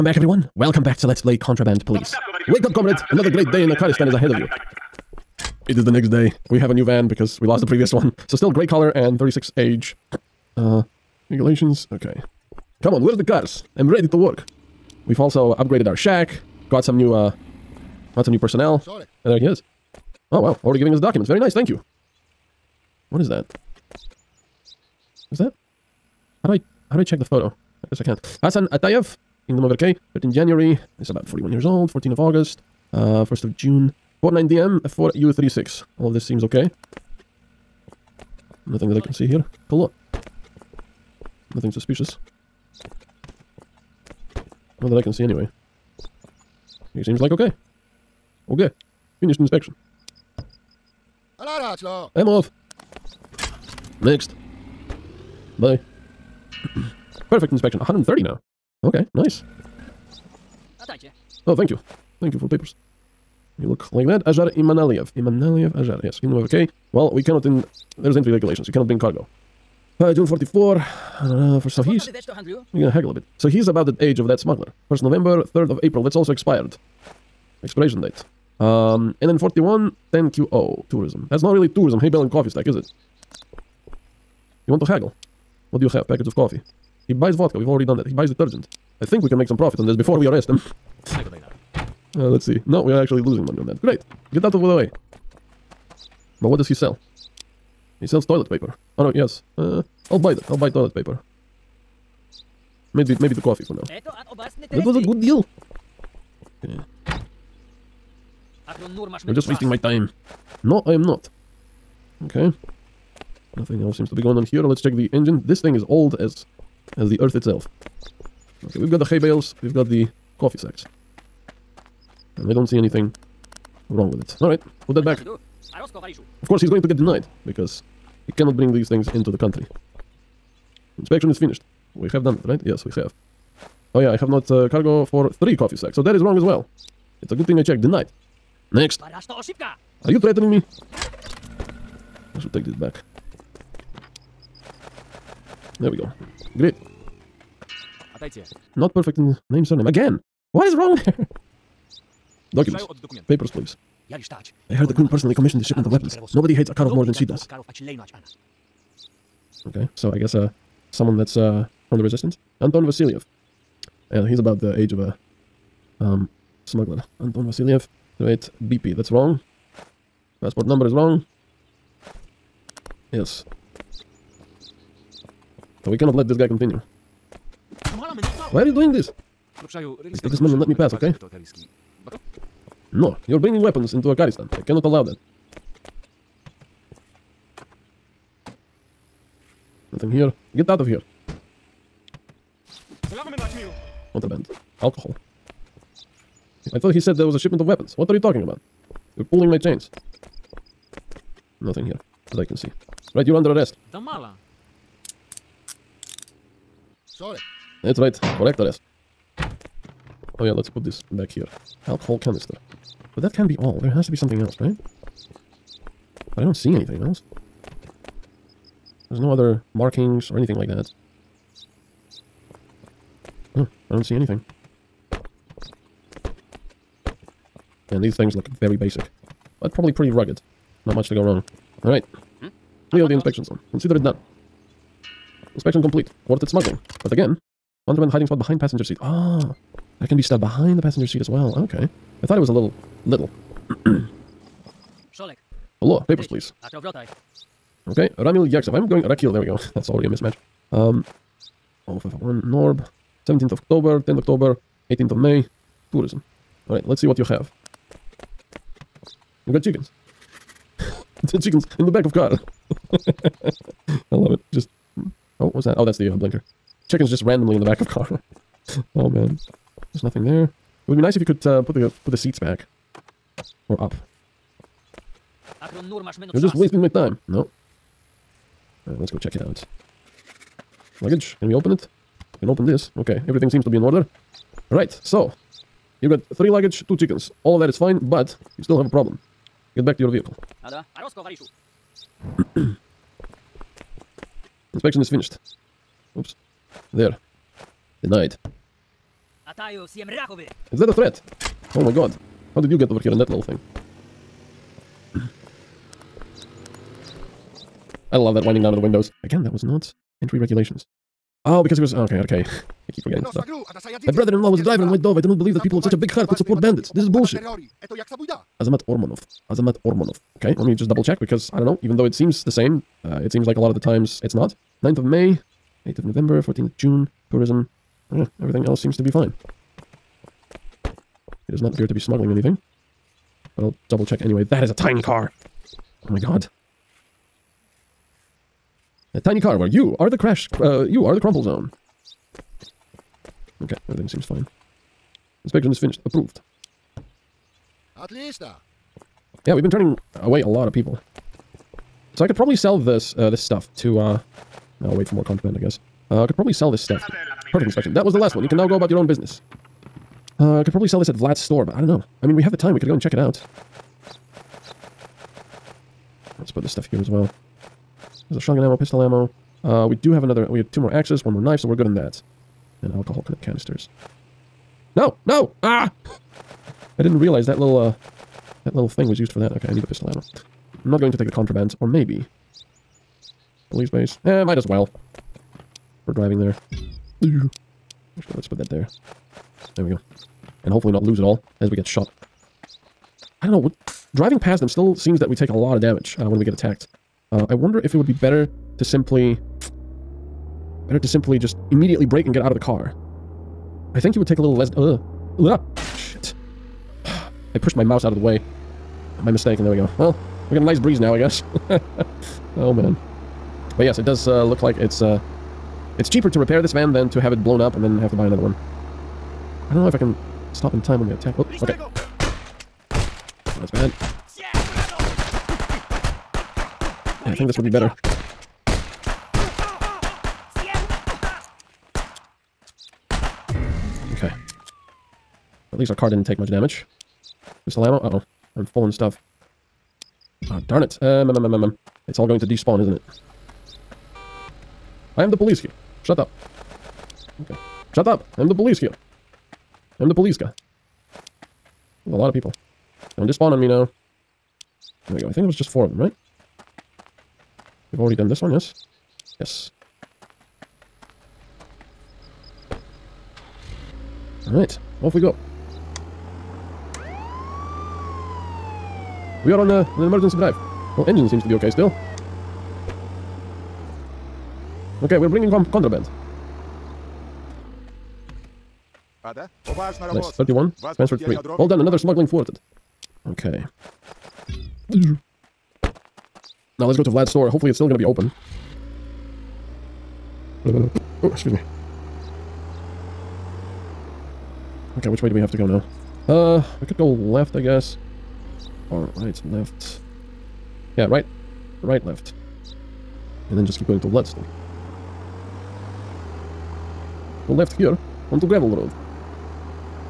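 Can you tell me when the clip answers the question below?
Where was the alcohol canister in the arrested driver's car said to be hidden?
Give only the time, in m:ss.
3:58.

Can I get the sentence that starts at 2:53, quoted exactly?
Yes, So we cannot let this guy continue.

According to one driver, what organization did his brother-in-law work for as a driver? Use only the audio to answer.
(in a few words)
White Dove.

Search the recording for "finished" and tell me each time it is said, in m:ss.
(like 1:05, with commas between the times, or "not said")
0:49, 2:11, 4:55, 5:45.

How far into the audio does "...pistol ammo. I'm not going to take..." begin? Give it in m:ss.
6:19.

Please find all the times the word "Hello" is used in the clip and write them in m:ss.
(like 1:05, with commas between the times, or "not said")
0:39, 4:05.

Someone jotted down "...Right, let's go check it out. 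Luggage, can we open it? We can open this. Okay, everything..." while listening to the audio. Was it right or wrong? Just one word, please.
right.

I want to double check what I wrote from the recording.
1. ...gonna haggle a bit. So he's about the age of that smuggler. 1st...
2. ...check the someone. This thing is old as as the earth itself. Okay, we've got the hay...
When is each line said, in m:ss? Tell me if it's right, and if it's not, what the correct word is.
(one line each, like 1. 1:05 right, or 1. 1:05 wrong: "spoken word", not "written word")
1. 1:12 right
2. 1:54 wrong: "engine", not "someone".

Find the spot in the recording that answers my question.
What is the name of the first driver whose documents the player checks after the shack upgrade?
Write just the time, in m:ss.
0:28.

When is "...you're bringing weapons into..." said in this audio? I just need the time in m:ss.
3:03.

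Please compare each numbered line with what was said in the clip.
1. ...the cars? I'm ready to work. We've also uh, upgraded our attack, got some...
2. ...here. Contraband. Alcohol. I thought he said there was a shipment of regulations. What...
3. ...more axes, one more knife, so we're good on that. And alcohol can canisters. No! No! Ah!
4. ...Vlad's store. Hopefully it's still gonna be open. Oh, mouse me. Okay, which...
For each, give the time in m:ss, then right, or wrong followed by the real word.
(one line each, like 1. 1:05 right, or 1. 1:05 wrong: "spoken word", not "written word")
1. 0:13 wrong: "shack", not "attack"
2. 3:10 wrong: "weapons", not "regulations"
3. 6:10 right
4. 8:07 wrong: "excuse", not "mouse".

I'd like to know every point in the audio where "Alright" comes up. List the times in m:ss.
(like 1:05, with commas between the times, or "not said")
2:04, 3:51, 4:16, 7:44.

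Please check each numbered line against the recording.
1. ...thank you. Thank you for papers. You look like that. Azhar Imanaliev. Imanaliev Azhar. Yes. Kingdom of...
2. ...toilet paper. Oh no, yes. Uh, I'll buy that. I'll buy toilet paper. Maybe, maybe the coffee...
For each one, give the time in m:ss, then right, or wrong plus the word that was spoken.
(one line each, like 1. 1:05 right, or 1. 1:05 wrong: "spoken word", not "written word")
1. 1:01 right
2. 1:38 right.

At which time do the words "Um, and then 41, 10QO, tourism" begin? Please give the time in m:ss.
1:18.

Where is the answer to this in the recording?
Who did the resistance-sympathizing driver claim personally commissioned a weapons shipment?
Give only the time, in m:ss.
2:34.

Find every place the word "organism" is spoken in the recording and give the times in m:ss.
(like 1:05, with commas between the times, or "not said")
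not said.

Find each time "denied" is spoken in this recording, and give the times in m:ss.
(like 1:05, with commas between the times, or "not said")
2:06, 2:17, 4:58.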